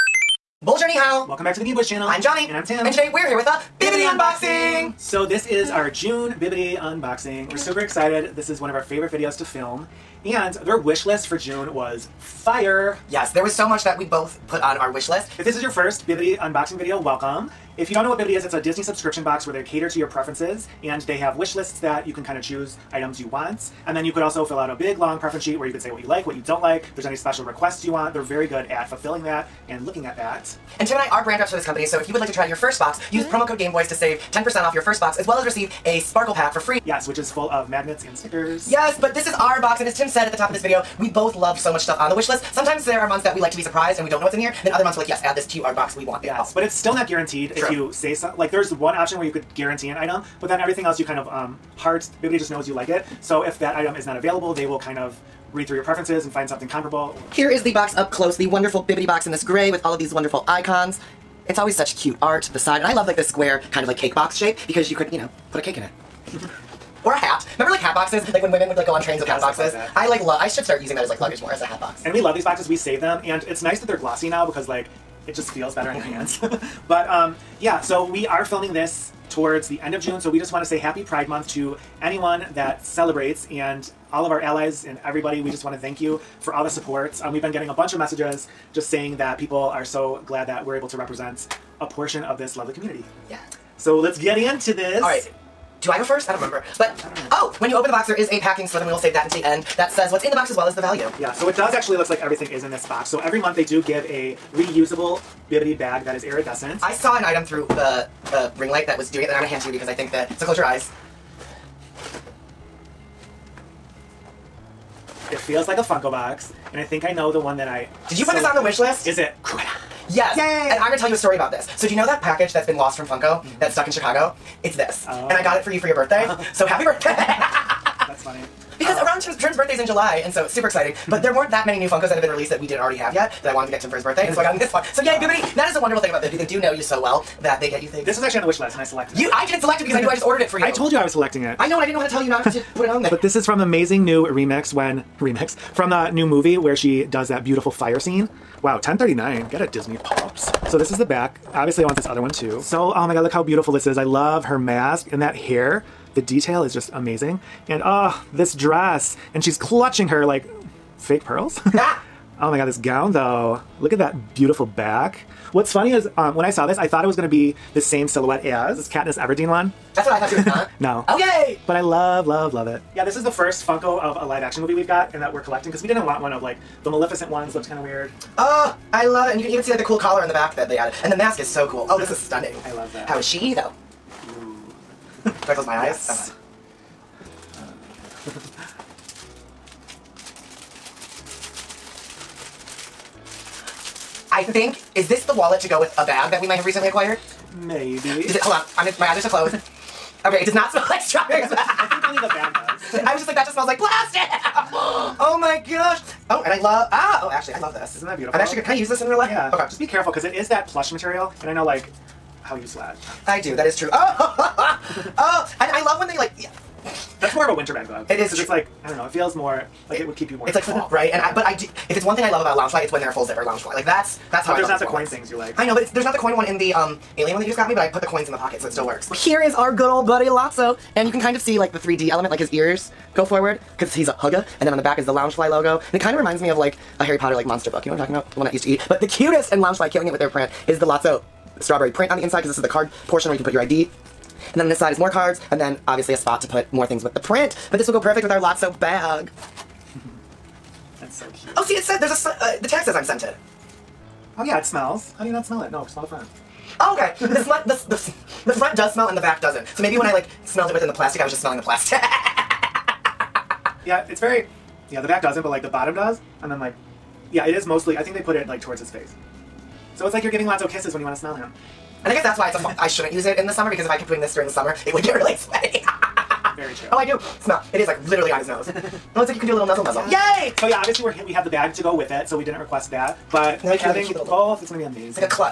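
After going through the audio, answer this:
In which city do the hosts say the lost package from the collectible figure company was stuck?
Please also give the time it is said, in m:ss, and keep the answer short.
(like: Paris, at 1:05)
Chicago, at 2:03.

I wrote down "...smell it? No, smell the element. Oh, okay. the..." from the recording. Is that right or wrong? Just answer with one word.
wrong.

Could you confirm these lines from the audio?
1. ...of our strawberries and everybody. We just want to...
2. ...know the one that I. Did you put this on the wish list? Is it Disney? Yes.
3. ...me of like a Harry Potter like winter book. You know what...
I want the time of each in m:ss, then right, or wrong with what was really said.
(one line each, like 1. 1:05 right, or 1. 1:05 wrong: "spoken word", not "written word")
1. 1:24 wrong: "allies", not "strawberries"
2. 1:57 wrong: "Cruella", not "Disney"
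3. 3:56 wrong: "monster", not "winter".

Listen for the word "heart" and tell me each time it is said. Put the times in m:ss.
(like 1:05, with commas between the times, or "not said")
0:51.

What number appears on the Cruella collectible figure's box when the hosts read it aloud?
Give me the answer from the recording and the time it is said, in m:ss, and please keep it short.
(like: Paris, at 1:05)
1039, at 2:28.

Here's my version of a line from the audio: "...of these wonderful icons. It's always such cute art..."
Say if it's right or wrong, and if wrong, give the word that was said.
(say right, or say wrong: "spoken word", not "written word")
right.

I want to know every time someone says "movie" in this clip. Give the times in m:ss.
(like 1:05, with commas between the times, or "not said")
2:26, 2:54.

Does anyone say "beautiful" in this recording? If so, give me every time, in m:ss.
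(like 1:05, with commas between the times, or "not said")
2:27, 2:33, 2:44, 3:28.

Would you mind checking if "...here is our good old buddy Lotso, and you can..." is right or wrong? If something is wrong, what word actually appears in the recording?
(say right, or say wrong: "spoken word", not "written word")
right.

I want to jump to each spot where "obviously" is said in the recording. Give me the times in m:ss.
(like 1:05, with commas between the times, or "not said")
2:31, 4:05, 4:40.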